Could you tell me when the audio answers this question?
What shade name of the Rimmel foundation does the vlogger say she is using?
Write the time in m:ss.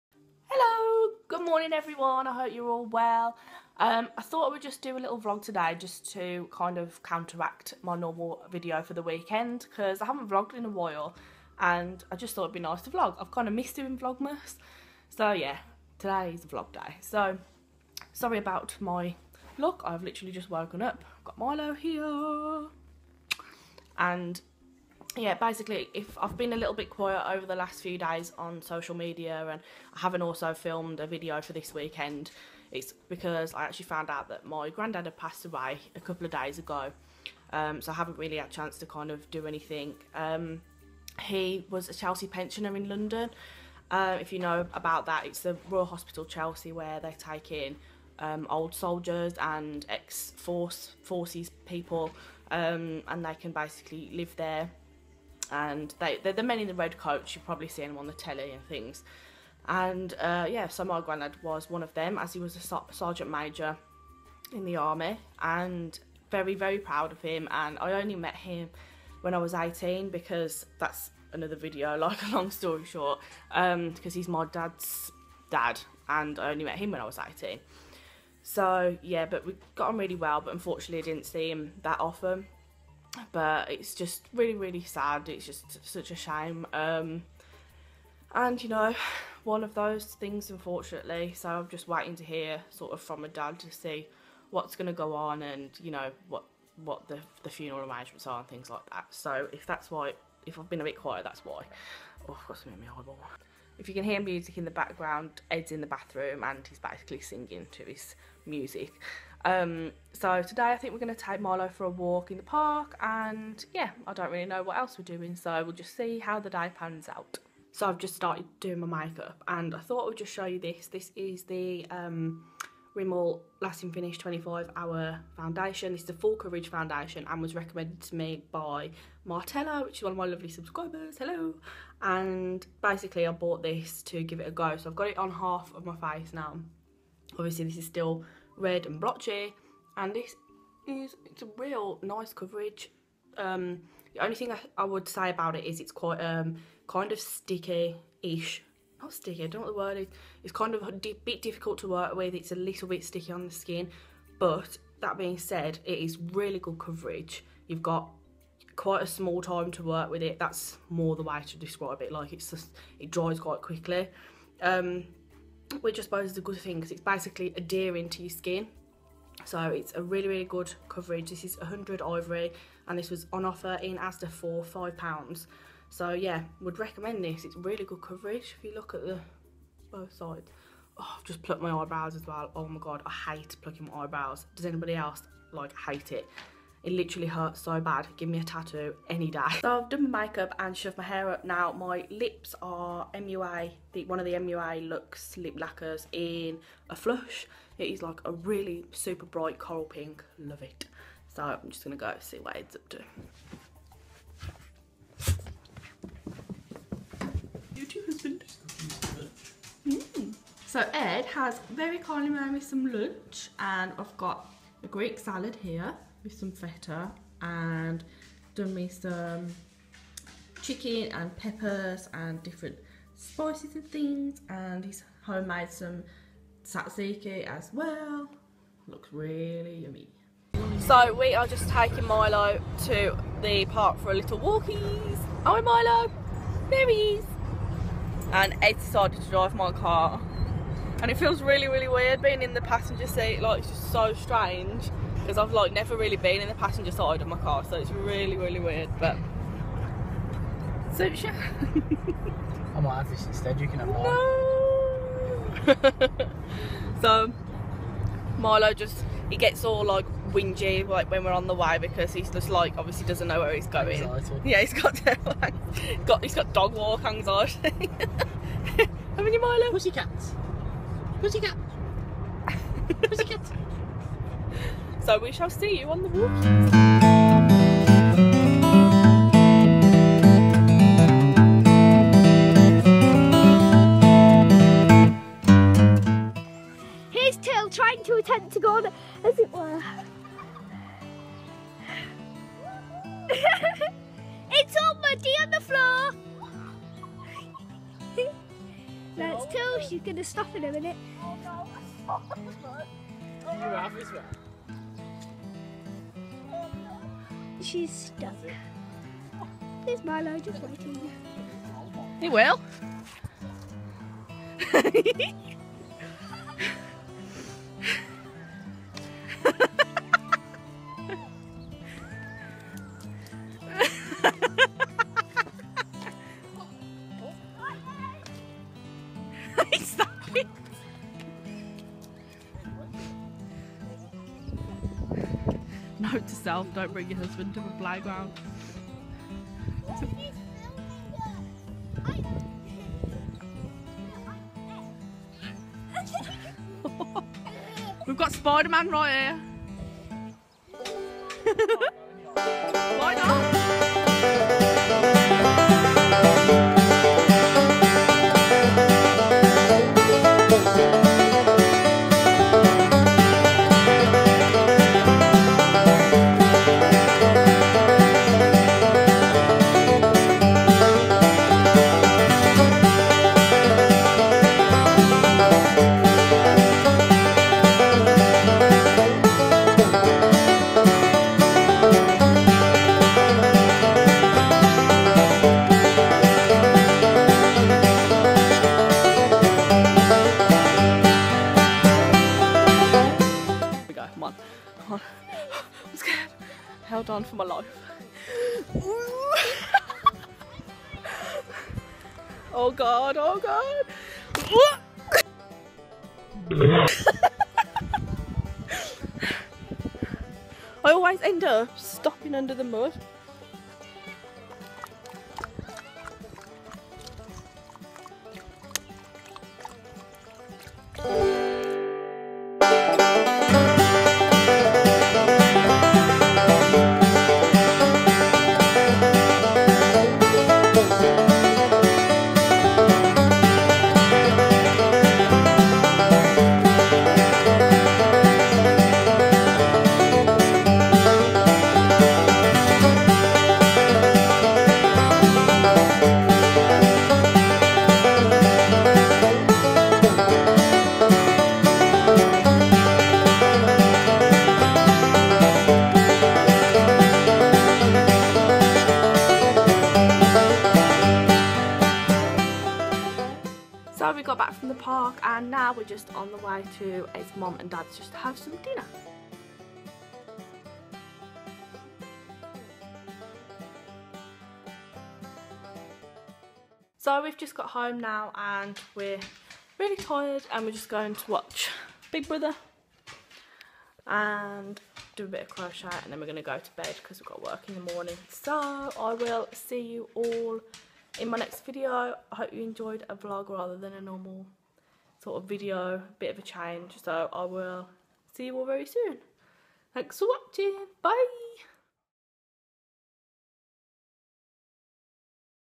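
2:51.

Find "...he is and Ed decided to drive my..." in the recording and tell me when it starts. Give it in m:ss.
3:56.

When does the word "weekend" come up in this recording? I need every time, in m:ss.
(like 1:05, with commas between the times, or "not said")
0:09, 0:31.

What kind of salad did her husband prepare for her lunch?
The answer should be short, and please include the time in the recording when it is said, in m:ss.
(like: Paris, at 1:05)
Greek salad, at 3:34.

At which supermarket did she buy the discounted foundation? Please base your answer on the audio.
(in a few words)
Asda.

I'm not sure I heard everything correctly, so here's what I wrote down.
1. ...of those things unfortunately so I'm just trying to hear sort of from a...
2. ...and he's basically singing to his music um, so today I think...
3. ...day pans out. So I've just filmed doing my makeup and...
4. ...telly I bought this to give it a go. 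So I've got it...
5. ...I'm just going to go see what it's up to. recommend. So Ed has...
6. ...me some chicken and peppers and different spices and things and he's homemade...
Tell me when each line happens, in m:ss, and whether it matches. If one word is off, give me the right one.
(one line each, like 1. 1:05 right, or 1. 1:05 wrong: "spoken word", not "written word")
1. 1:29 wrong: "waiting", not "trying"
2. 1:46 right
3. 1:56 wrong: "started", not "filmed"
4. 2:12 wrong: "basically", not "telly"
5. 3:21 wrong: "husband", not "recommend"
6. 3:38 right.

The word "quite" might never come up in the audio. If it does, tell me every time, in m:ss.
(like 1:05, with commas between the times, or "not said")
2:25, 2:38, 2:43.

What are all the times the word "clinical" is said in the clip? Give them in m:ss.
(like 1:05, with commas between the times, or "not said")
not said.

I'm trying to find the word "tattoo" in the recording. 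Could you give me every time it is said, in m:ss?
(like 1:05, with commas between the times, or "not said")
3:08.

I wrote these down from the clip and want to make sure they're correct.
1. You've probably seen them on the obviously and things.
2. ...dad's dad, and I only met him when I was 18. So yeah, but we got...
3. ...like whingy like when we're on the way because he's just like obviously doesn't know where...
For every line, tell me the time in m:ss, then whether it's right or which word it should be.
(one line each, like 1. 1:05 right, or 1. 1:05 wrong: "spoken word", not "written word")
1. 0:57 wrong: "telly", not "obviously"
2. 1:14 right
3. 4:19 right.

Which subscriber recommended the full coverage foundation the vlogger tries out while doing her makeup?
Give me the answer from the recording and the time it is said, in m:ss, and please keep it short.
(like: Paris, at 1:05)
Martella, at 2:09.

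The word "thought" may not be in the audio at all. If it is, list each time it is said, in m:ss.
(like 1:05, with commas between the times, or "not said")
0:04, 0:12, 1:59.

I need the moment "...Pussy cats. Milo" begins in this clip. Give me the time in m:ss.
4:29.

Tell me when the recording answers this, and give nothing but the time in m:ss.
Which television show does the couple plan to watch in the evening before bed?
8:02.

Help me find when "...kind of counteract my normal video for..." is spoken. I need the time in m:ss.
0:06.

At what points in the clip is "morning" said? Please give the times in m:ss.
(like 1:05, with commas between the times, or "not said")
0:01, 8:07.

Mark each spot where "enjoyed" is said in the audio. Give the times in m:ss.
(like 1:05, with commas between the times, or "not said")
8:12.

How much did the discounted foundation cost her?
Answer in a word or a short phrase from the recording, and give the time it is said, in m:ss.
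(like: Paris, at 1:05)
£5, at 2:54.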